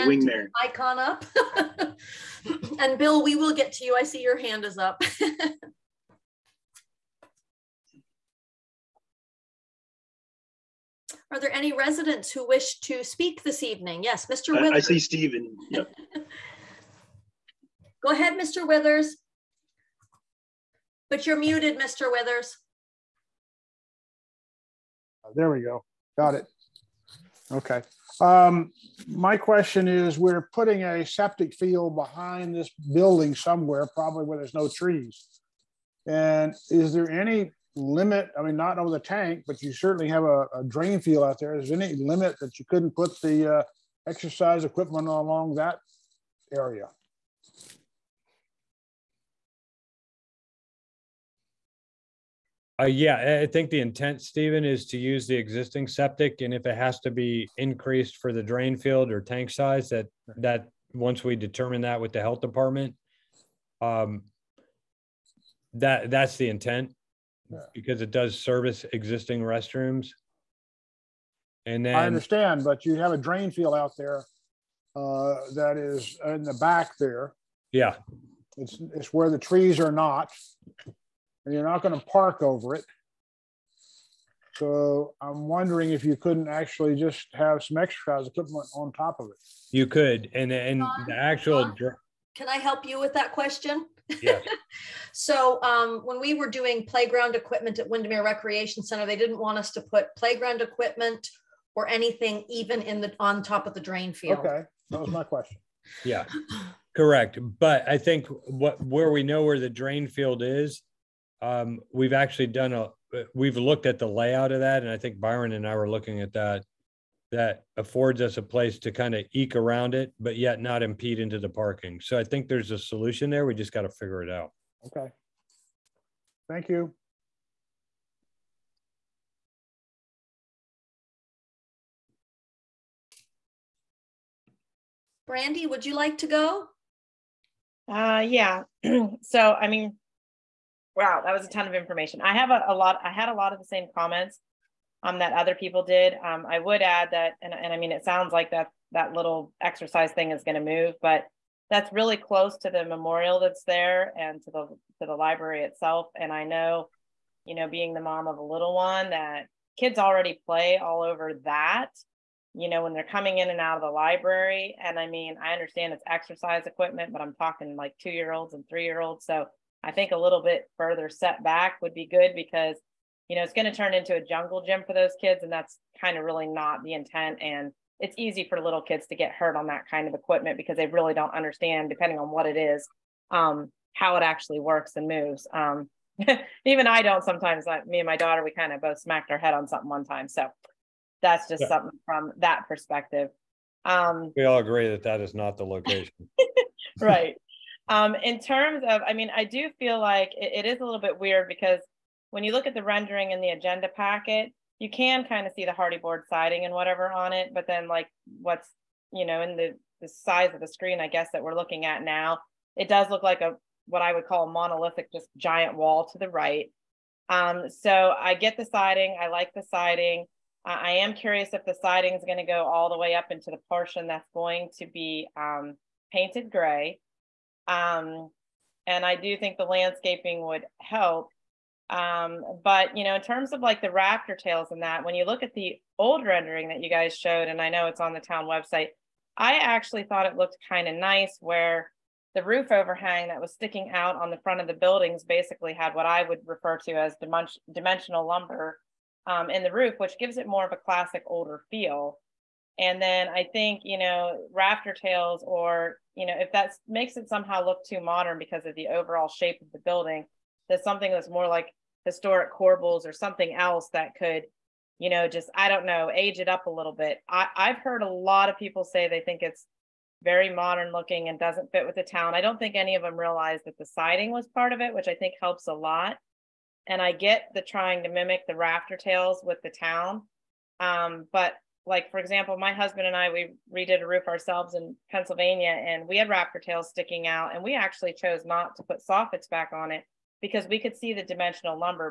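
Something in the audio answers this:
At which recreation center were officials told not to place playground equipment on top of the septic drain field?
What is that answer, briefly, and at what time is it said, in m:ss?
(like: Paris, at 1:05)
Windermere Recreation Center, at 1:37.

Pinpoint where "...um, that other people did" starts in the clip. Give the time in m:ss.
2:25.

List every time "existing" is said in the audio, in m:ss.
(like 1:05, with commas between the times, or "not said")
0:55, 1:08.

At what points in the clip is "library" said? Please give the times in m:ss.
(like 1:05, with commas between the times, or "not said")
2:35, 2:43.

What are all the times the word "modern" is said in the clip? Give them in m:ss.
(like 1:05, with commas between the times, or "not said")
4:17, 4:30.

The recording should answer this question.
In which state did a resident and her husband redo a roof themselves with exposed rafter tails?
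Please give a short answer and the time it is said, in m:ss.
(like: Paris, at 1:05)
Pennsylvania, at 4:45.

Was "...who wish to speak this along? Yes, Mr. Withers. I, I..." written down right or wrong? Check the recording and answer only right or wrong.
wrong.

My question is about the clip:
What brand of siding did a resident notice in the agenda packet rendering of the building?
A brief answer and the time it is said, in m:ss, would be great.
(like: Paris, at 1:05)
Hardie board, at 3:25.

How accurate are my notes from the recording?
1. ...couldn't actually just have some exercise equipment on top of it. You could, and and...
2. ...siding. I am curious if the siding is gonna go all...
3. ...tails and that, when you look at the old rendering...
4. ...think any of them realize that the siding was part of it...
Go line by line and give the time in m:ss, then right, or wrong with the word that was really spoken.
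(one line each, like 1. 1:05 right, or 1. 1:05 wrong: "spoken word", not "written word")
1. 1:26 right
2. 3:39 right
3. 3:54 right
4. 4:32 right.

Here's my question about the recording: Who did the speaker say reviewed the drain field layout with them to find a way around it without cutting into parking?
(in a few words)
Byron.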